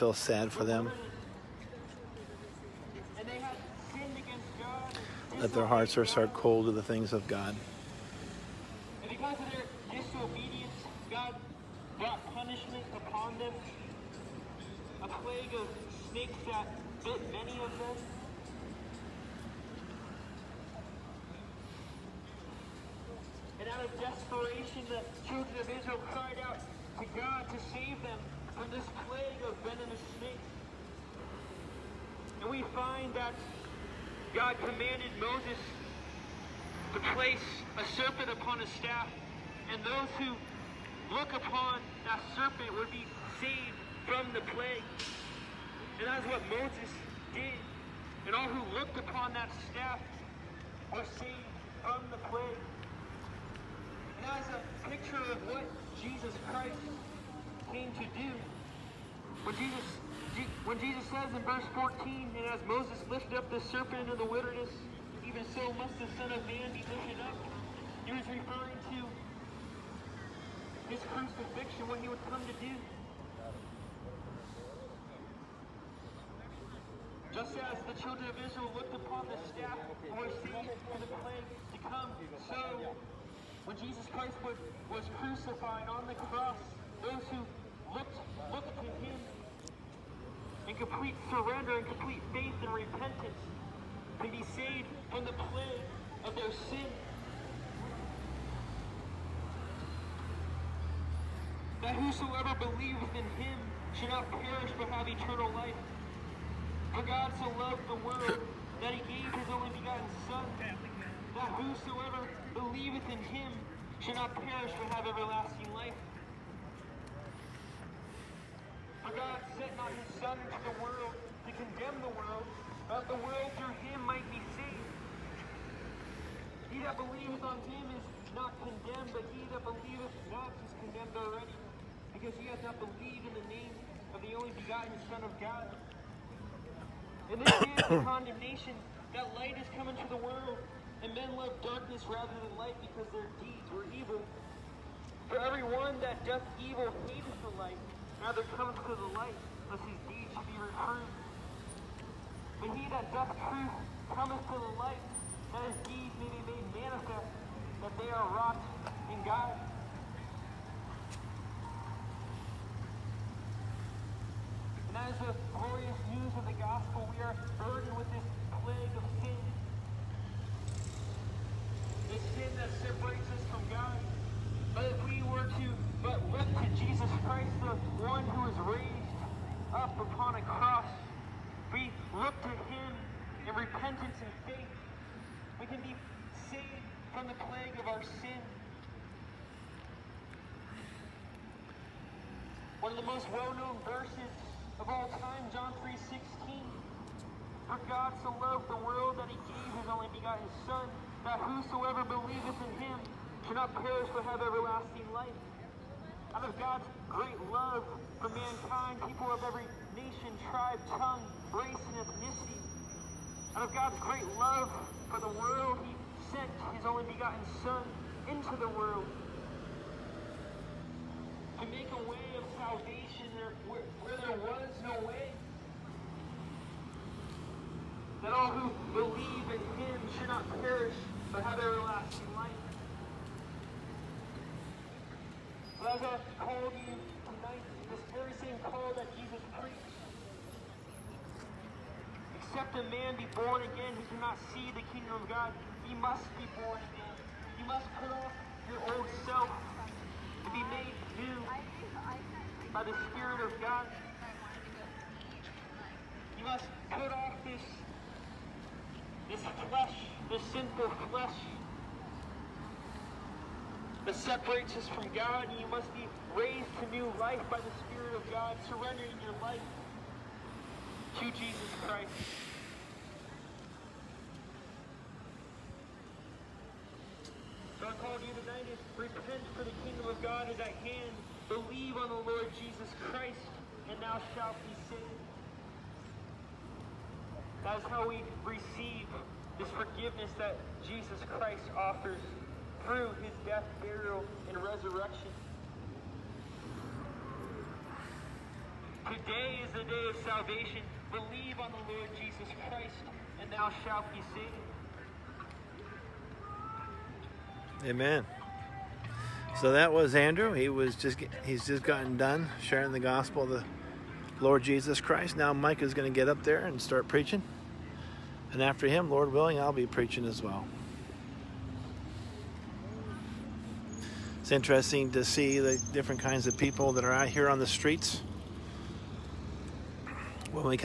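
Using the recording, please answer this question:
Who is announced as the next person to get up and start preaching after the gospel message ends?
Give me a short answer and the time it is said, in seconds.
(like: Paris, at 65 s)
Mike, at 315 s.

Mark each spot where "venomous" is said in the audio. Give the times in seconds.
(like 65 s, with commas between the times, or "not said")
29 s.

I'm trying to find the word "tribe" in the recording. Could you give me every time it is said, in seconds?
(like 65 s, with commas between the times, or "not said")
210 s.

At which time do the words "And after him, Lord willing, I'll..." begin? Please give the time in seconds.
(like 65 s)
318 s.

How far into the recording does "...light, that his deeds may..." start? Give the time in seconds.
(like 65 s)
154 s.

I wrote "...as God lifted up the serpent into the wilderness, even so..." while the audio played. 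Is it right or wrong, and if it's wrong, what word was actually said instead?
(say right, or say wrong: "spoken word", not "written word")
wrong: "Moses", not "God".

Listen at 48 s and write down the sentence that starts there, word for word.
And all who looked upon that staff were saved from the plague.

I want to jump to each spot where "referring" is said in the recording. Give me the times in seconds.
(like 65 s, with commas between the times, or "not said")
68 s.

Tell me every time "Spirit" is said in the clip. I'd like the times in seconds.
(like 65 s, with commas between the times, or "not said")
253 s, 267 s.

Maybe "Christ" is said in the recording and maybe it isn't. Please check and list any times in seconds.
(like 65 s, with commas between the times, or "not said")
56 s, 84 s, 177 s, 271 s, 283 s, 291 s, 302 s, 314 s.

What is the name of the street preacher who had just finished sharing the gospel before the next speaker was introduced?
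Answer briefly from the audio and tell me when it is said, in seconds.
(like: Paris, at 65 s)
Andrew, at 309 s.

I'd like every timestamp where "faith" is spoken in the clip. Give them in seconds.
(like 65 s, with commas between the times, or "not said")
92 s, 184 s.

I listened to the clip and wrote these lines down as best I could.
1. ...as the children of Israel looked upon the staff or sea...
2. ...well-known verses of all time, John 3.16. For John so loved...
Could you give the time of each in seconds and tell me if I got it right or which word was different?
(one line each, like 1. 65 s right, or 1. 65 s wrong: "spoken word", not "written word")
1. 77 s right
2. 193 s wrong: "God", not "John".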